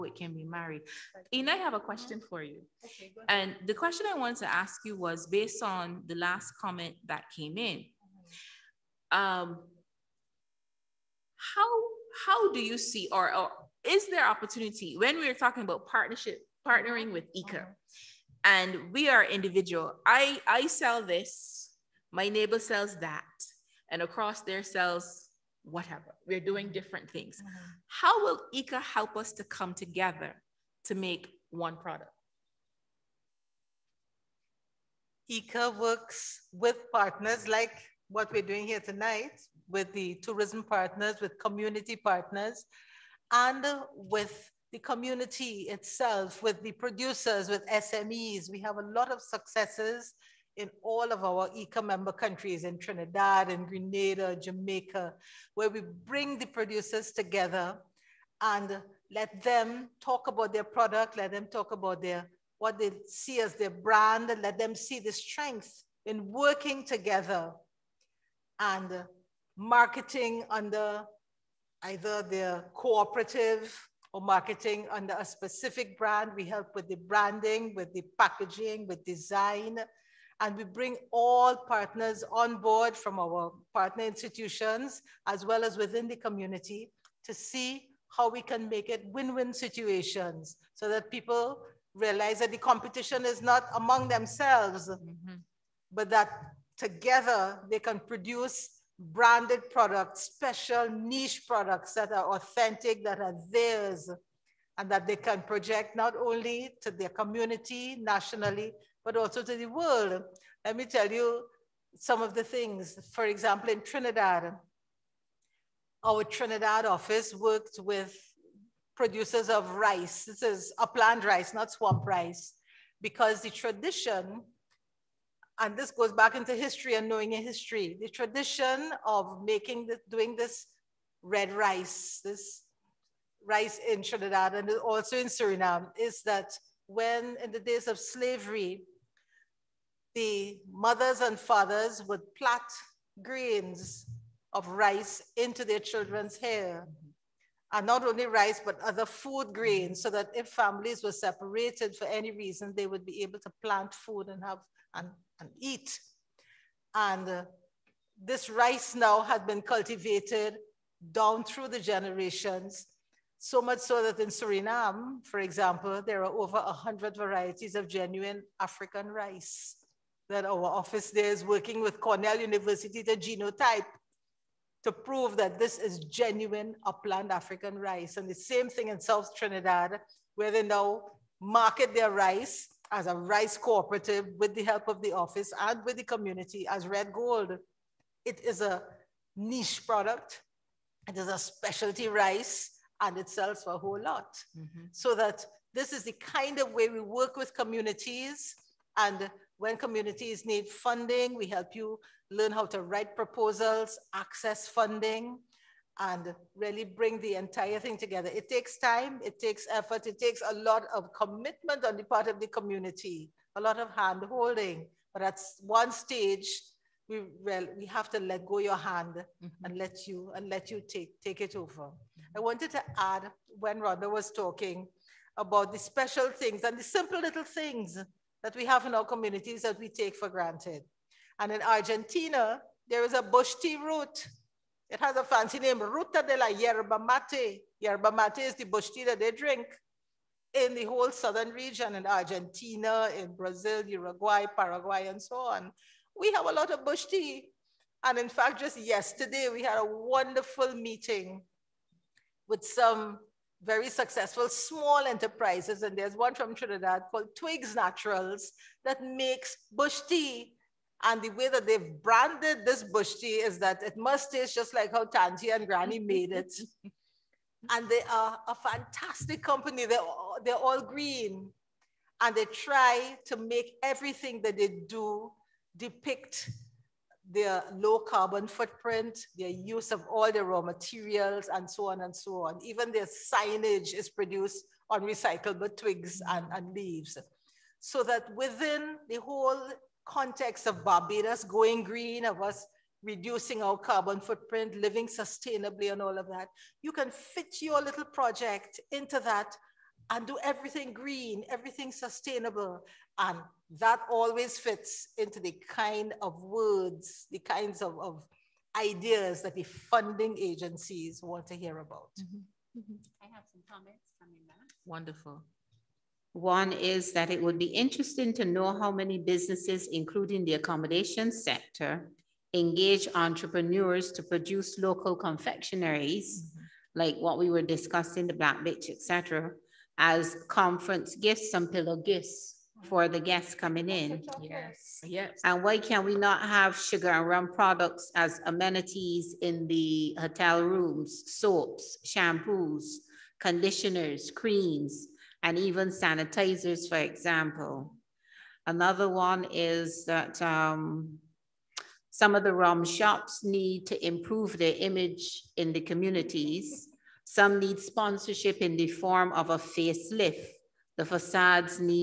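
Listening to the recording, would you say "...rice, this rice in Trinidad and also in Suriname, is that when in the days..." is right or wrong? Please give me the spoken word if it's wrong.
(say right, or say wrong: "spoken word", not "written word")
right.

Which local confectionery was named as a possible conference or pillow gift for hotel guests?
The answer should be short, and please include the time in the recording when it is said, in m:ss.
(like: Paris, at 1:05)
Black Bitch, at 5:28.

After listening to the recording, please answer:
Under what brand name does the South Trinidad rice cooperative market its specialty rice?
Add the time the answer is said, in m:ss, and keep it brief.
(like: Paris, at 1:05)
Red Gold, at 3:06.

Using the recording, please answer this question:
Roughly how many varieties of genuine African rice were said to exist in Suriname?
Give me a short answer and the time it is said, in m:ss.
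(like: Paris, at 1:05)
over 100, at 2:46.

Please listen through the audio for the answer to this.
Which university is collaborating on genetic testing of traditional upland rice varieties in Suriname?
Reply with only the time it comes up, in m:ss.
2:51.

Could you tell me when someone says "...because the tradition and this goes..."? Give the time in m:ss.
2:03.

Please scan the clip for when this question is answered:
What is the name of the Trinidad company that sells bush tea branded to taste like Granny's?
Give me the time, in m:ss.
4:17.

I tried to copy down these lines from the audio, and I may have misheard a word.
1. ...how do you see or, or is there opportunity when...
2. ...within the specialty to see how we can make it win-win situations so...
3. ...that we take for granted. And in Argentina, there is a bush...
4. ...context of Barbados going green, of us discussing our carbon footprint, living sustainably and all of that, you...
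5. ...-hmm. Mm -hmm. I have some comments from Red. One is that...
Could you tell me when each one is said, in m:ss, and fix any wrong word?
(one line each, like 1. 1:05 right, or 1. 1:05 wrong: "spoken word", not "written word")
1. 0:12 right
2. 1:25 wrong: "community", not "specialty"
3. 3:49 right
4. 4:50 wrong: "reducing", not "discussing"
5. 5:12 wrong: "Wonderful", not "Red".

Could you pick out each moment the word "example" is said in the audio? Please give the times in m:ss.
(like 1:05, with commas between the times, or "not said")
1:53, 2:45, 5:46.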